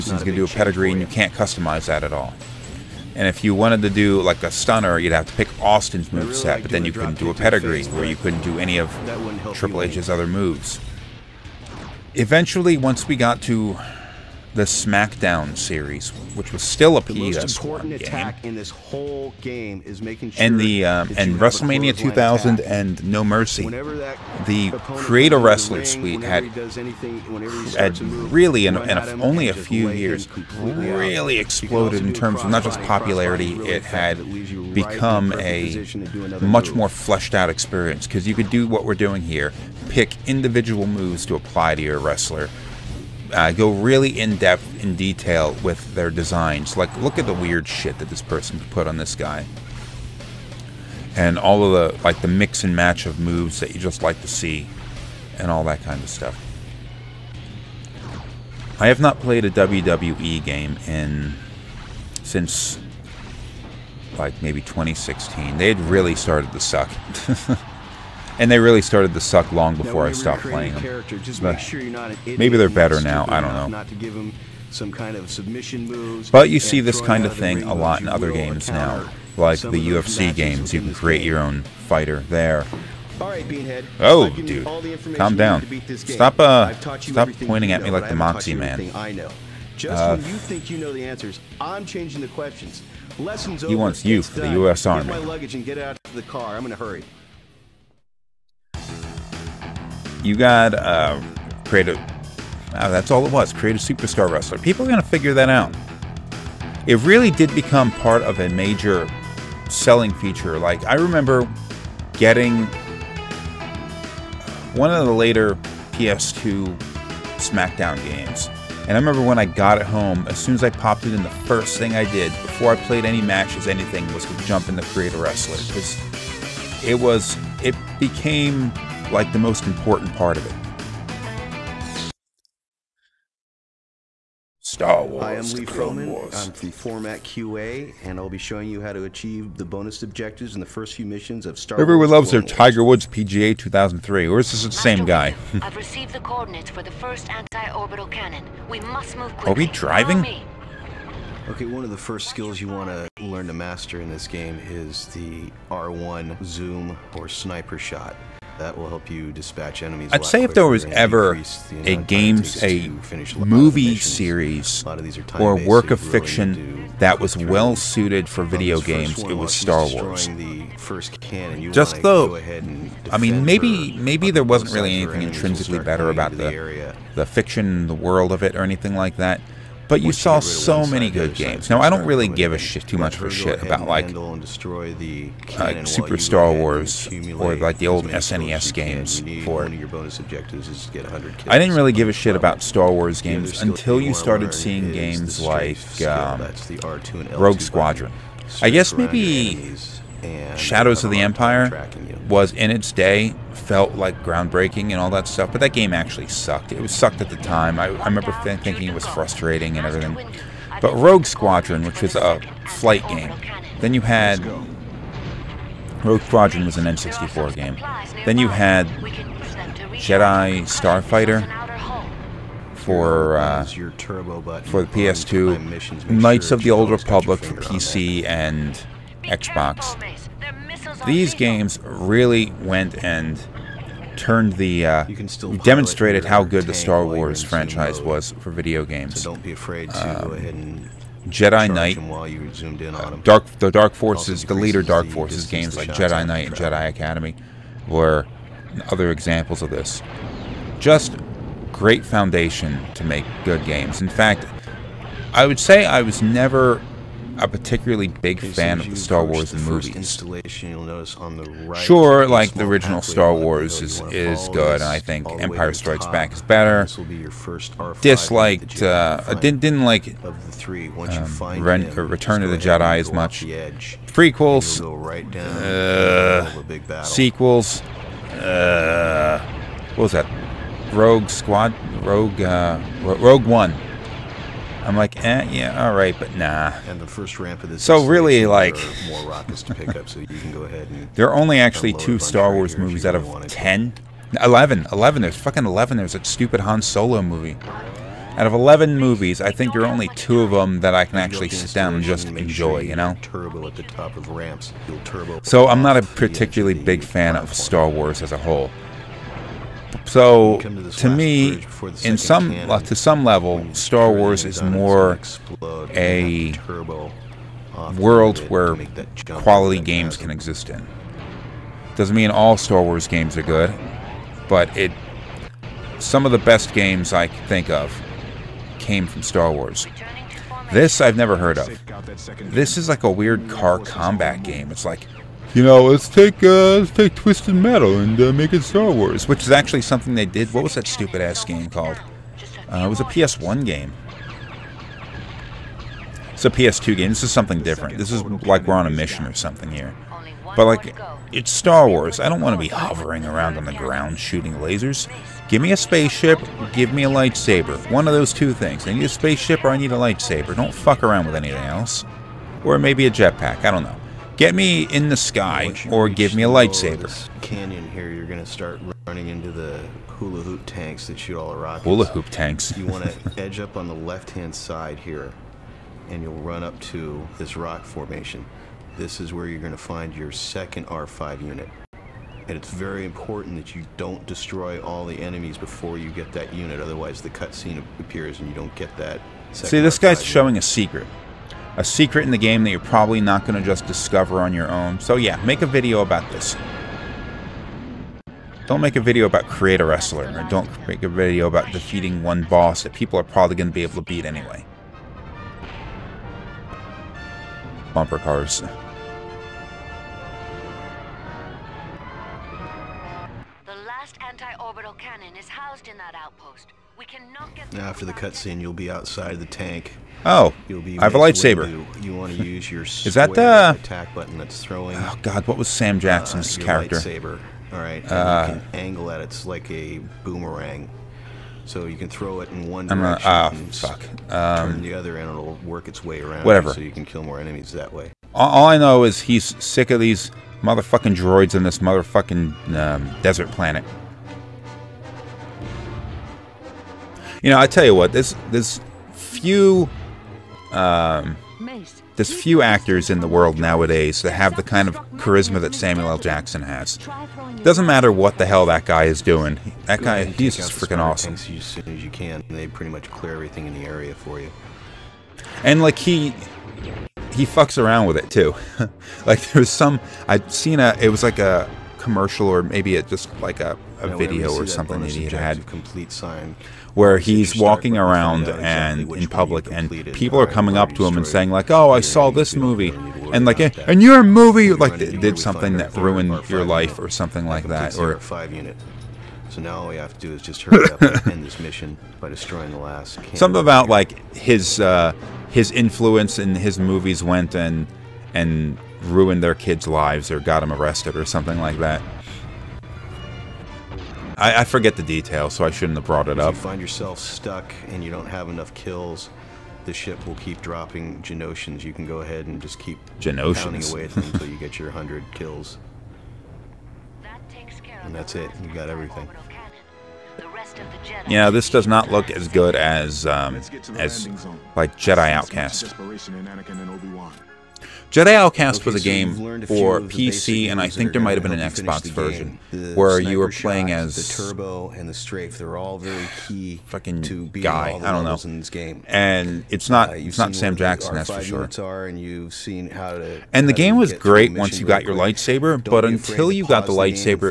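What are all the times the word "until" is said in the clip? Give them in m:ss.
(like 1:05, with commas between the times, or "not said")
3:13, 8:34, 9:06.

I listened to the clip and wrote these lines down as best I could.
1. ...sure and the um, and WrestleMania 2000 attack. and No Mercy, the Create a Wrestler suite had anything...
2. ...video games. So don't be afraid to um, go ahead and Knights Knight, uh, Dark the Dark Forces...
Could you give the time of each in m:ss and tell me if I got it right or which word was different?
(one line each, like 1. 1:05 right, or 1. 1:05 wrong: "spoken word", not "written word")
1. 0:20 right
2. 3:58 wrong: "Jedi", not "Knights".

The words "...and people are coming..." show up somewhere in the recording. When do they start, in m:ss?
7:59.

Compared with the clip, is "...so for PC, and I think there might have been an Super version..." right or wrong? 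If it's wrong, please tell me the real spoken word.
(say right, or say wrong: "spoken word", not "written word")
wrong: "Xbox", not "Super".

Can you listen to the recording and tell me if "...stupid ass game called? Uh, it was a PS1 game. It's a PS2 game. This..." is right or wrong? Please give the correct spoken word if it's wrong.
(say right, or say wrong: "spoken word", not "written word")
right.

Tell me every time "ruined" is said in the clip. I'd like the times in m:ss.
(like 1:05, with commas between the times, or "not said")
8:05, 8:19.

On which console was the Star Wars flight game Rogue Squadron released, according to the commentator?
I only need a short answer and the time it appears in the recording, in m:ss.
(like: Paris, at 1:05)
N64, at 3:36.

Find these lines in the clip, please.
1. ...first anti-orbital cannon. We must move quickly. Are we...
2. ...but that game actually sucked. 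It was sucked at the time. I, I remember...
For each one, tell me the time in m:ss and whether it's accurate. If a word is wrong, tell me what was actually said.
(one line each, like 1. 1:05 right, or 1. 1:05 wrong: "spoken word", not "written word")
1. 2:26 right
2. 3:25 right.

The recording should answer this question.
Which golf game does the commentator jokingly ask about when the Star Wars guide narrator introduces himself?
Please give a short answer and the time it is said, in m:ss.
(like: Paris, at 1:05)
Tiger Woods PGA 2003, at 2:22.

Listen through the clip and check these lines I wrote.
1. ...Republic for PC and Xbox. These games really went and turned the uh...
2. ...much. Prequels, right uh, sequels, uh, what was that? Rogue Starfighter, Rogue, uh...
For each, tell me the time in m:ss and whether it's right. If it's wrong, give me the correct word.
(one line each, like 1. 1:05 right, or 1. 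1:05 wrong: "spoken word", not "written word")
1. 3:46 right
2. 4:33 wrong: "Squad", not "Starfighter".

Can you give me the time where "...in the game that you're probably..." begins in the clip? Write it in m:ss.
6:32.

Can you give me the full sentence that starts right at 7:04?
Oh God, what was Sam uh, Jackson's uh, character?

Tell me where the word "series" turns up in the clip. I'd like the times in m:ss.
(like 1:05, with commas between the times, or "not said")
0:15, 2:43.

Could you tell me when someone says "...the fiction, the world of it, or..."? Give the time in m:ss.
2:57.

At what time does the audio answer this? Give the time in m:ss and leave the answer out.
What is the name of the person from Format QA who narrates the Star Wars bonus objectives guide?
2:15.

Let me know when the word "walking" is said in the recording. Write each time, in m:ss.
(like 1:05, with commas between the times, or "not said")
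7:57.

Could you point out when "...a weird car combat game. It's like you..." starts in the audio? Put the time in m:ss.
5:33.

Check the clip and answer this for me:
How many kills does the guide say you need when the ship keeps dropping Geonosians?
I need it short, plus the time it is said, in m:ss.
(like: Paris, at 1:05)
100, at 8:34.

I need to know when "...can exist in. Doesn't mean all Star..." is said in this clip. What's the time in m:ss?
5:20.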